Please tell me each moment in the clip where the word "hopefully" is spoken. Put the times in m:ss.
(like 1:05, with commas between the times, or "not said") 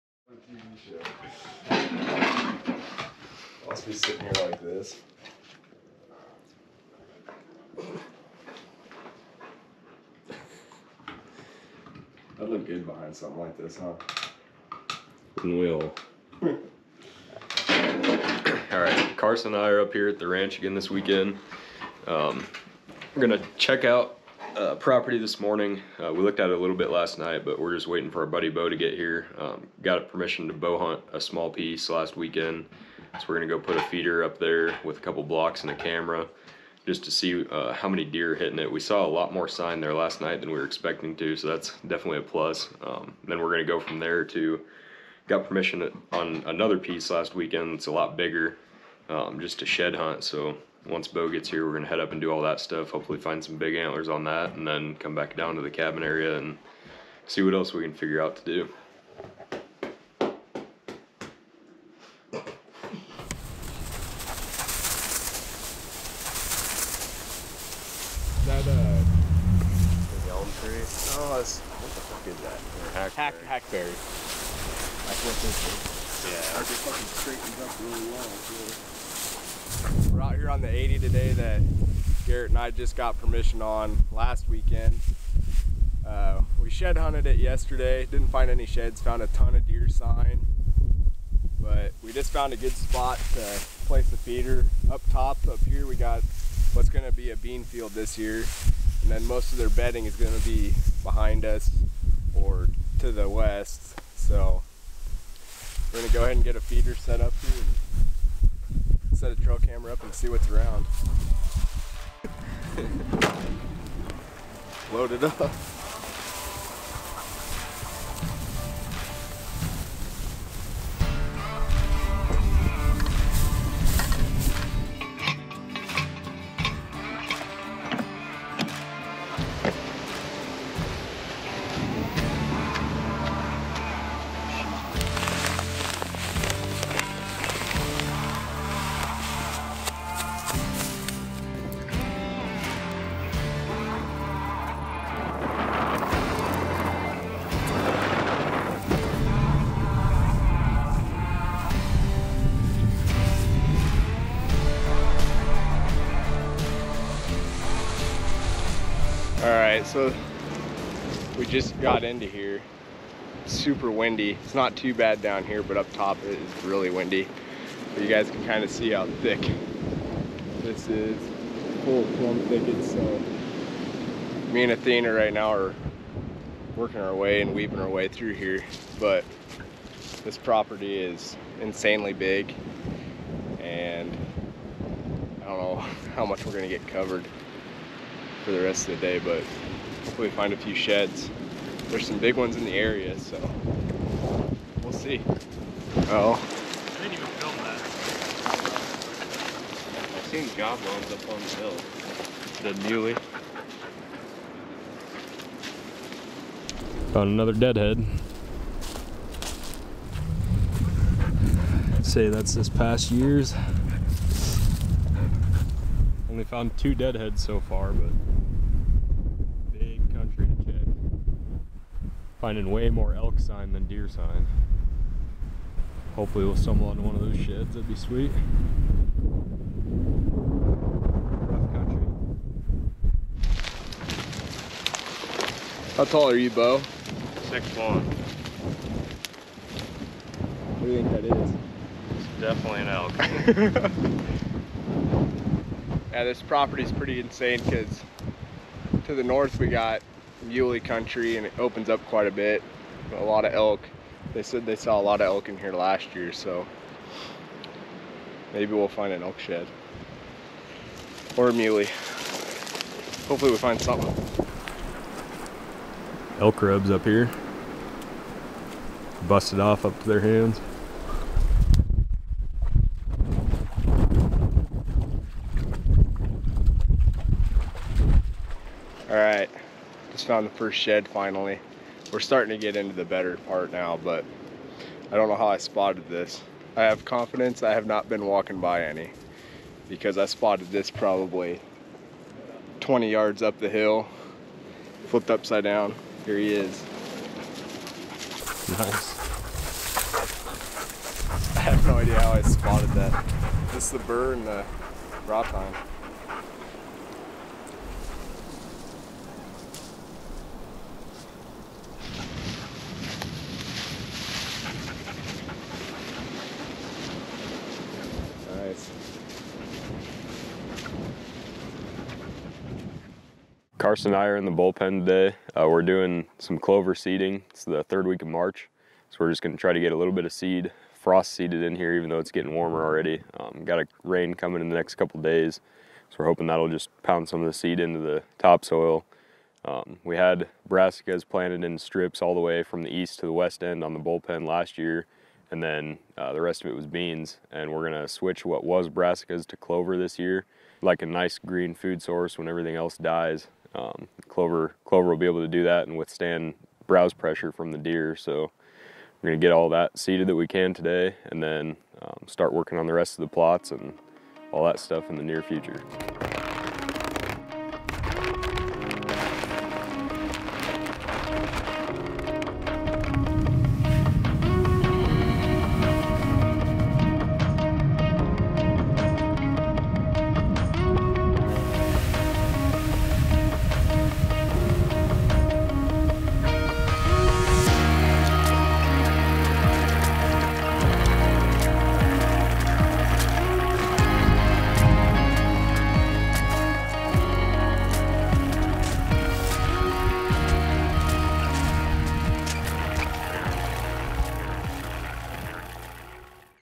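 0:52, 3:10, 3:46, 4:23.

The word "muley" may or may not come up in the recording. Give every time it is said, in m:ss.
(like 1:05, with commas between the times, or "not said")
4:10, 4:21.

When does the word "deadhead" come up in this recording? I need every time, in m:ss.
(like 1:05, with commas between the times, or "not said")
3:27, 3:36.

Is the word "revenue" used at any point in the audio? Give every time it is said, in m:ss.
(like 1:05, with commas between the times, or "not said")
not said.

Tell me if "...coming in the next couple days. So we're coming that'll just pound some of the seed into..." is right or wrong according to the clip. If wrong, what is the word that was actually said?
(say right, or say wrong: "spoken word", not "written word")
wrong: "hoping", not "coming".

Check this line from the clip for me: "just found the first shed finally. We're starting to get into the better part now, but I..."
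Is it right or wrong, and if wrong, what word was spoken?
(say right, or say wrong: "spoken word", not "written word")
right.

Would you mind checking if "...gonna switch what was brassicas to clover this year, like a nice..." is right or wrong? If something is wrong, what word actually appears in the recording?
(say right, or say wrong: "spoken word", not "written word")
right.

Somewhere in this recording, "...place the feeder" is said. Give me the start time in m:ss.
1:33.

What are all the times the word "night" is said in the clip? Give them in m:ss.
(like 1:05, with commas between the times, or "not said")
0:27, 0:40.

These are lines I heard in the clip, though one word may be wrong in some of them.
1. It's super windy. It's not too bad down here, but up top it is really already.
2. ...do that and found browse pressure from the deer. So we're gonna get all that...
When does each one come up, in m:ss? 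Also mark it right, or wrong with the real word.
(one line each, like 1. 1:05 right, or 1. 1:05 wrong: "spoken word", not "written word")
1. 2:43 wrong: "windy", not "already"
2. 5:55 wrong: "withstand", not "found".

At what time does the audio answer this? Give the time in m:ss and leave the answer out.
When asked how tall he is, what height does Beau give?
3:57.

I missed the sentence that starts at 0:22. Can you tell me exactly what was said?
Um, we're gonna check out uh, property this morning.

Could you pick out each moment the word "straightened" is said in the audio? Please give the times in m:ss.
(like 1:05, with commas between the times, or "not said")
1:17.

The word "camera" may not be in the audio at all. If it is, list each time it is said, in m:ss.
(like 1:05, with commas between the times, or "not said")
0:35, 1:49.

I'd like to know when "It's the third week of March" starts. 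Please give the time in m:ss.
5:27.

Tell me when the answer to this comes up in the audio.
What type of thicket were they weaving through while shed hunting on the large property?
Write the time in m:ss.
2:51.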